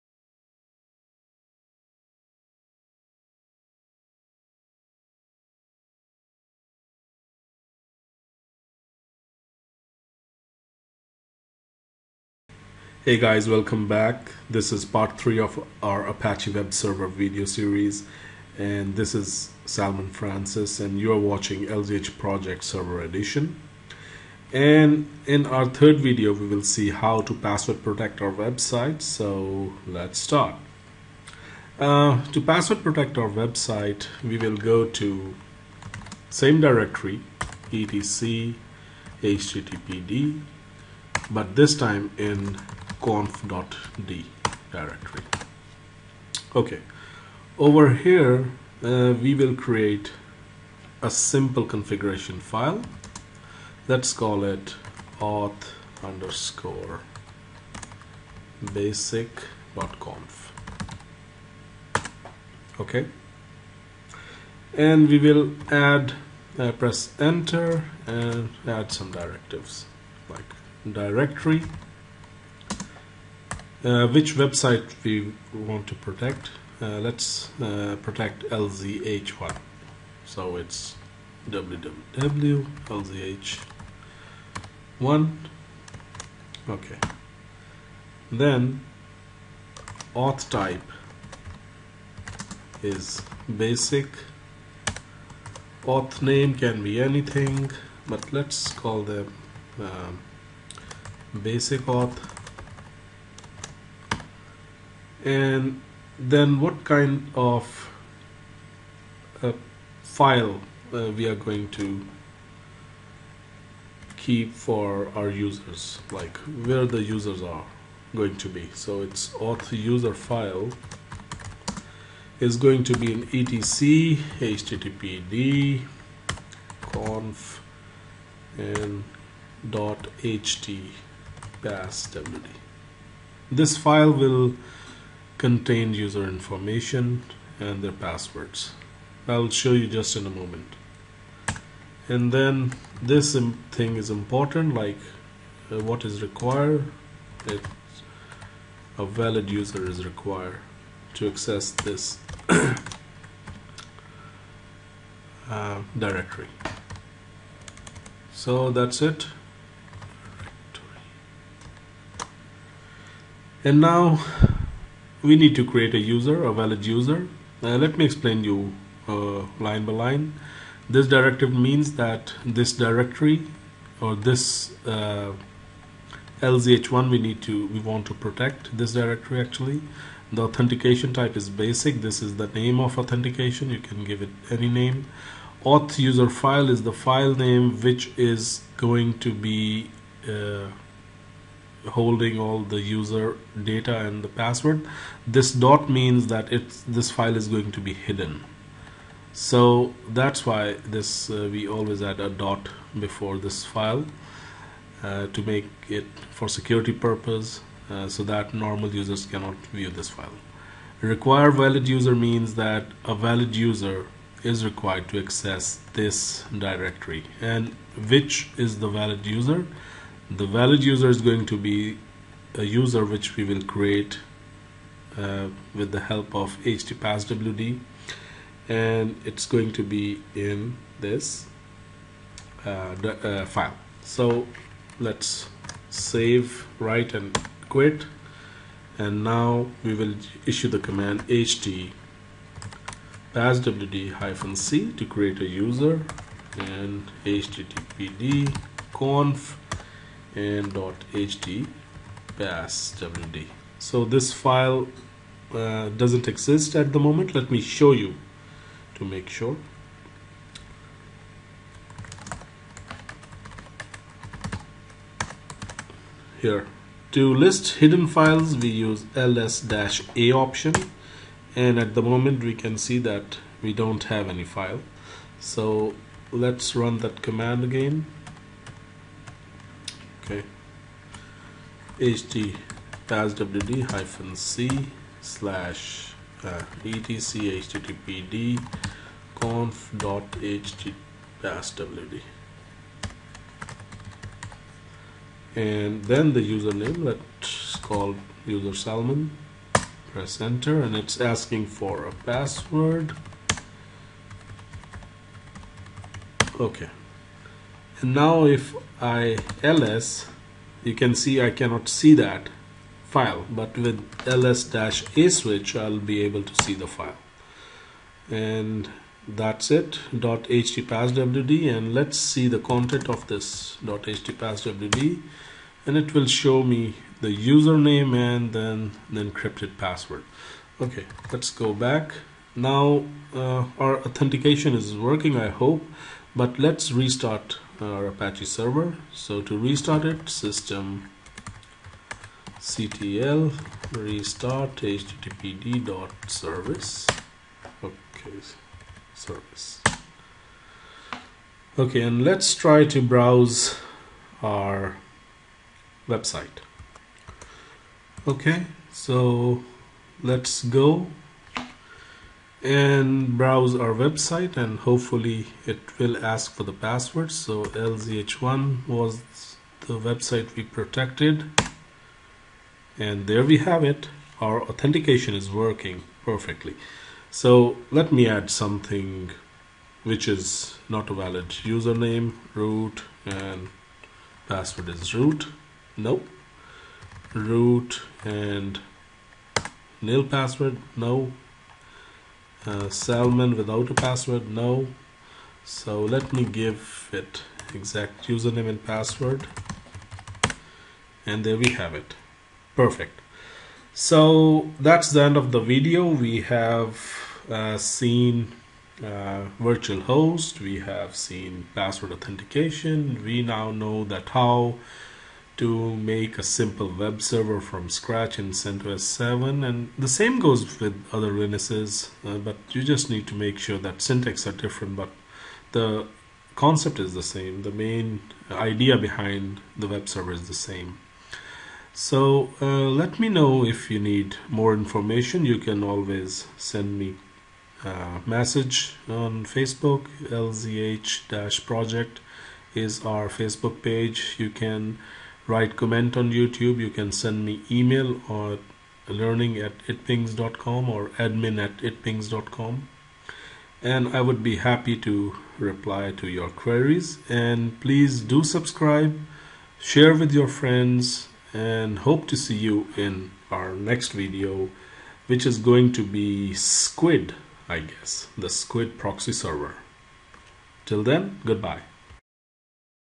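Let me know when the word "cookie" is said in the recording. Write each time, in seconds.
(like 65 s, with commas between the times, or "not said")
not said.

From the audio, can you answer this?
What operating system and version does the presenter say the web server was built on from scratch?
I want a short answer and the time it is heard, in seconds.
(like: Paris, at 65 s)
CentOS 7, at 418 s.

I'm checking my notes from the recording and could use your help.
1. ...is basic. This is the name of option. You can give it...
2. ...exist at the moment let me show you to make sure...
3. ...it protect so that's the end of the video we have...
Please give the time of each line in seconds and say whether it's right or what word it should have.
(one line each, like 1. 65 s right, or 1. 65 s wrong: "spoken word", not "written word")
1. 181 s wrong: "authentication", not "option"
2. 256 s right
3. 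401 s wrong: "perfect", not "protect".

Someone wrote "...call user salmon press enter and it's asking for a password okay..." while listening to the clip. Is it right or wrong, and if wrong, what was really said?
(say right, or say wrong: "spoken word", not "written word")
right.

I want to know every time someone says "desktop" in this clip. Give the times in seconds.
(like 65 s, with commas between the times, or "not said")
not said.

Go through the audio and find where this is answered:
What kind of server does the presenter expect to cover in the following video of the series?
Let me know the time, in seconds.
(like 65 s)
468 s.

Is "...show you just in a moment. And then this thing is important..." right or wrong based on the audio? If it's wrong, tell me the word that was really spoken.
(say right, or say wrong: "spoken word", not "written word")
right.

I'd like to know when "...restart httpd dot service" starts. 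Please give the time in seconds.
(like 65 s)
343 s.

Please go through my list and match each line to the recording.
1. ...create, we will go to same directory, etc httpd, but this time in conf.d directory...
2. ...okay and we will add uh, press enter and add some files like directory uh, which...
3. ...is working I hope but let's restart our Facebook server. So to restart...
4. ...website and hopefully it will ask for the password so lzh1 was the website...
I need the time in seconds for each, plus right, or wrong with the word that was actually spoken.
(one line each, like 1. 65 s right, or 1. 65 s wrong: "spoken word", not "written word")
1. 33 s wrong: "website", not "create"
2. 62 s wrong: "directives", not "files"
3. 334 s wrong: "Apache", not "Facebook"
4. 363 s right.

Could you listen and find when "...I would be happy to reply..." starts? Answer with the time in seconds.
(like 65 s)
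454 s.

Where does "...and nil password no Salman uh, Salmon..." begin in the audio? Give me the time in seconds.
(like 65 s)
388 s.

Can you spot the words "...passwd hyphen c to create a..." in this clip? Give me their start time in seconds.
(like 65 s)
243 s.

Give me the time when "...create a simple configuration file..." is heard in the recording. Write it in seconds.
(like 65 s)
49 s.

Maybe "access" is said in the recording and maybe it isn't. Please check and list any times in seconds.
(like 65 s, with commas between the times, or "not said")
151 s, 215 s.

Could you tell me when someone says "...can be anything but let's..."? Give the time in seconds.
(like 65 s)
96 s.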